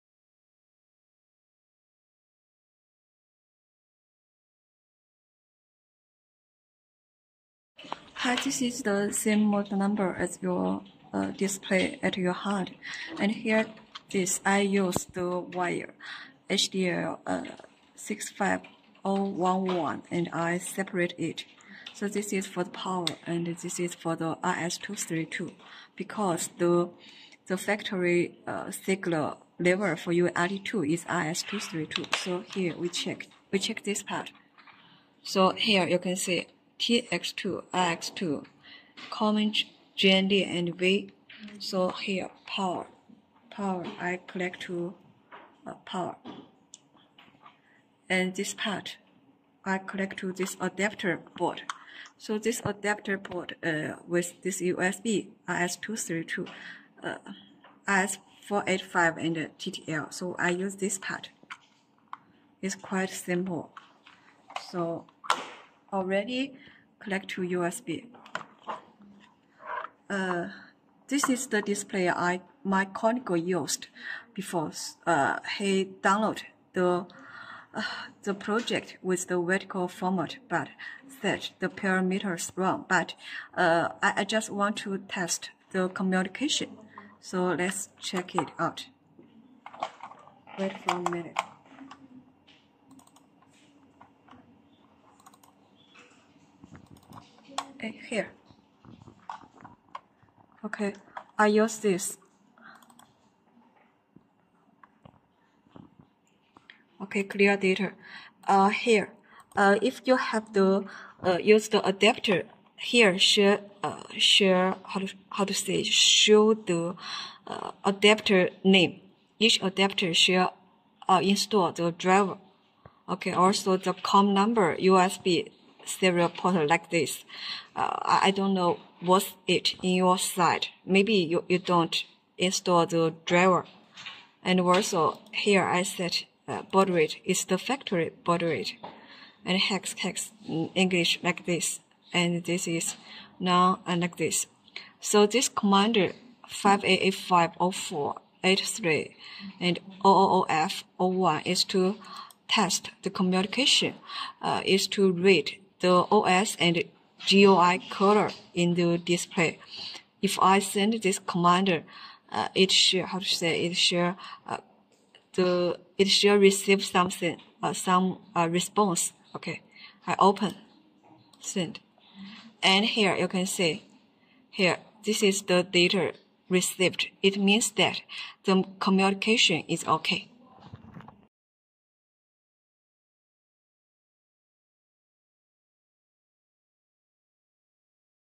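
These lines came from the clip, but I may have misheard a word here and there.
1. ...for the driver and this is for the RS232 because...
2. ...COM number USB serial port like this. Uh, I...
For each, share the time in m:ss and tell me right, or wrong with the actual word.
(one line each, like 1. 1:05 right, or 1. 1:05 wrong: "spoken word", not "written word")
1. 0:22 wrong: "power", not "driver"
2. 2:03 right.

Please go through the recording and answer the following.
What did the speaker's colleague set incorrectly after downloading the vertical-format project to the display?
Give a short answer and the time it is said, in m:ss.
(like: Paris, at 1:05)
the parameters, at 1:21.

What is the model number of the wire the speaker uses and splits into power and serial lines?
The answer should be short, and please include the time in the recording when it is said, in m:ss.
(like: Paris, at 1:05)
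HDL 65011, at 0:16.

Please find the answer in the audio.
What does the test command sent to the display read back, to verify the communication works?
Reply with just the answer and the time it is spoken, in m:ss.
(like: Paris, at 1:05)
OS and GUI, at 2:36.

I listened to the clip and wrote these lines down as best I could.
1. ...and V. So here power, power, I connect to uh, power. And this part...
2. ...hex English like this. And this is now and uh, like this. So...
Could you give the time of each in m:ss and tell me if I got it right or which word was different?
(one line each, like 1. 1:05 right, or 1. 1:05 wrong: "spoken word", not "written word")
1. 0:40 right
2. 2:19 right.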